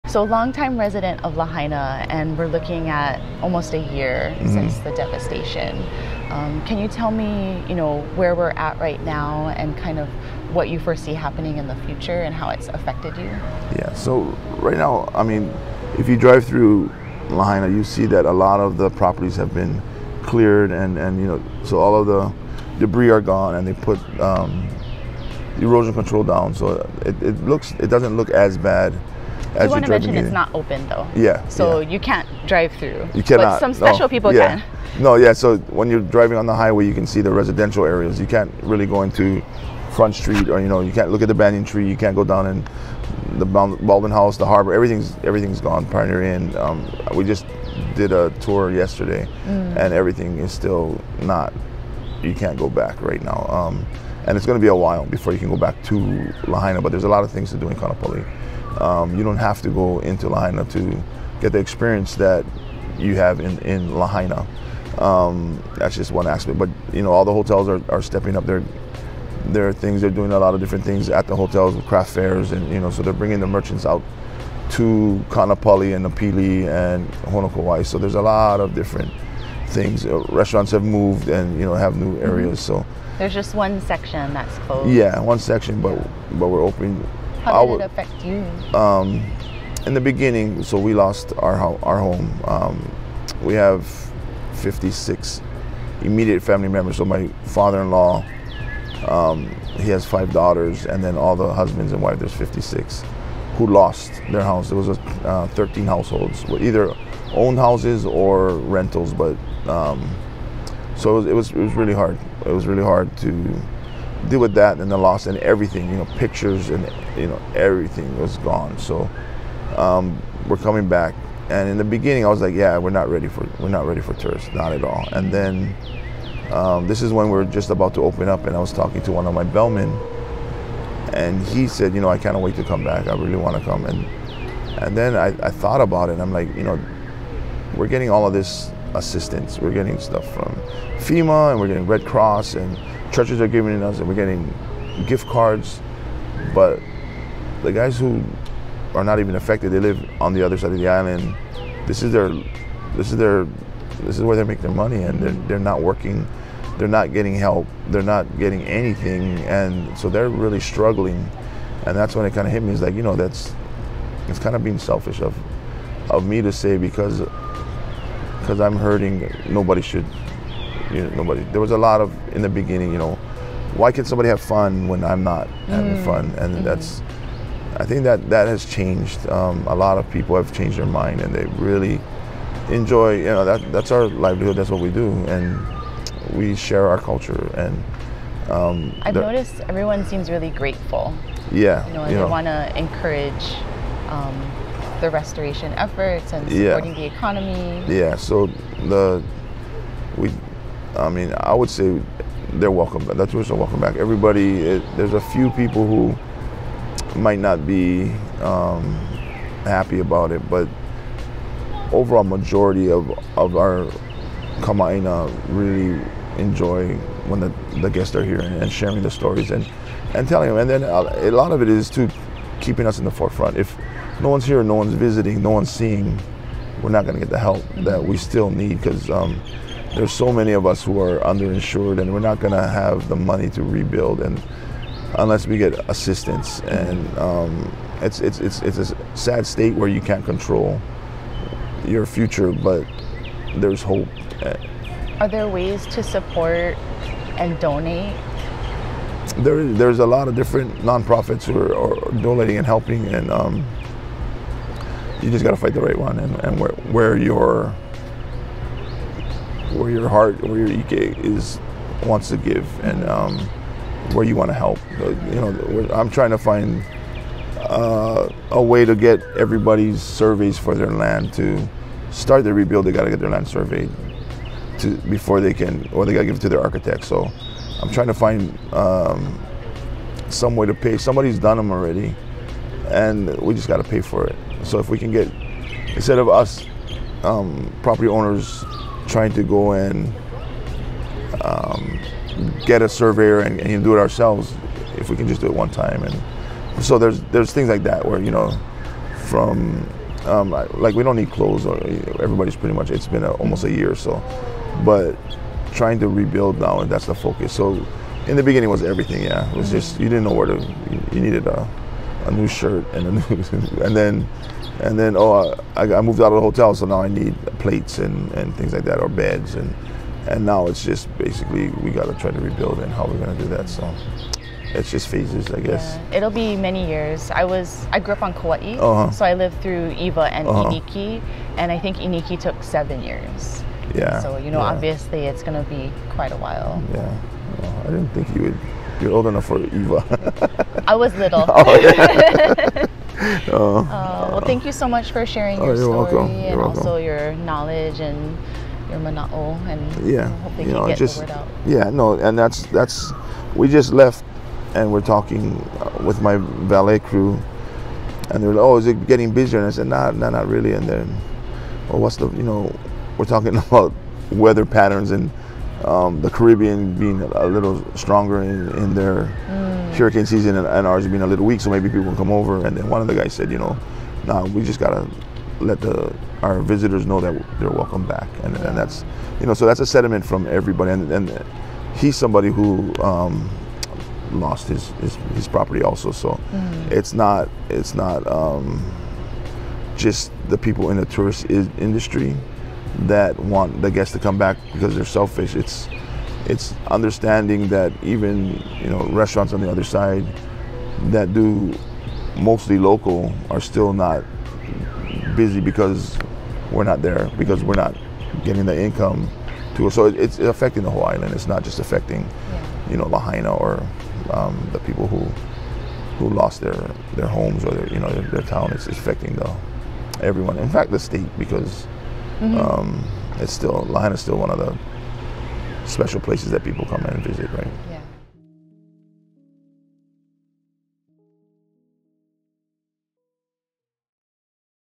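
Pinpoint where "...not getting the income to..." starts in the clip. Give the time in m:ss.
6:47.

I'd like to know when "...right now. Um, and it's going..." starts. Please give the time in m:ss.
0:53.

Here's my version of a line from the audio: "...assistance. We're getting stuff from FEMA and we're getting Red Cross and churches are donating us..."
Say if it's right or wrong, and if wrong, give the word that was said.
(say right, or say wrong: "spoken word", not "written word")
wrong: "giving", not "donating".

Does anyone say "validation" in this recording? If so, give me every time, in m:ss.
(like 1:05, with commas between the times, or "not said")
not said.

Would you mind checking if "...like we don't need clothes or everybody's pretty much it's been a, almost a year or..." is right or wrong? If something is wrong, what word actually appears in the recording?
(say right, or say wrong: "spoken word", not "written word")
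right.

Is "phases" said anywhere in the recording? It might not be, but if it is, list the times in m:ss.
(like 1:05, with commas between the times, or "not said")
5:25.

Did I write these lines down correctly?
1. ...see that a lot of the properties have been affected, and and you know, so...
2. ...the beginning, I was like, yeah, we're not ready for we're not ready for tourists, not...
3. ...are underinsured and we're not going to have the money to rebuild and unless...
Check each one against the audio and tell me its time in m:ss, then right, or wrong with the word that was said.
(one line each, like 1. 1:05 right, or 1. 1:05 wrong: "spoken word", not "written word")
1. 0:17 wrong: "cleared", not "affected"
2. 2:01 right
3. 3:51 right.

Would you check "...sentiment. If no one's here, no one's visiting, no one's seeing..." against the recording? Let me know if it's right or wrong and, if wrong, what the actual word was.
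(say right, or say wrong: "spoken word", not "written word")
wrong: "forefront", not "sentiment".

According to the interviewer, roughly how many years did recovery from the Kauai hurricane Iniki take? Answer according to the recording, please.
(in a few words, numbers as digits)
7.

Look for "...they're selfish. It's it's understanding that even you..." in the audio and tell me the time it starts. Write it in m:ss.
6:34.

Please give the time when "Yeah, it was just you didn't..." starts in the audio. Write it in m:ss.
5:09.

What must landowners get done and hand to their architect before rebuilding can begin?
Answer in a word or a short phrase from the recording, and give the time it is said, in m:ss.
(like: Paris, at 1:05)
land surveyed, at 4:33.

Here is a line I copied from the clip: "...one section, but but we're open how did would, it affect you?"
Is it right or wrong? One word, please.
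right.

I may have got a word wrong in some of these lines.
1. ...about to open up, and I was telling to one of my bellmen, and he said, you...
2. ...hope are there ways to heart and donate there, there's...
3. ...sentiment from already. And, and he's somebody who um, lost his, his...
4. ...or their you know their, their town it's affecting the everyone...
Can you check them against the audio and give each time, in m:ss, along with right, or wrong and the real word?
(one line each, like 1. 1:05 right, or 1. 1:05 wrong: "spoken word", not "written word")
1. 2:07 wrong: "talking", not "telling"
2. 4:03 wrong: "support", not "heart"
3. 6:19 wrong: "everybody", not "already"
4. 6:57 right.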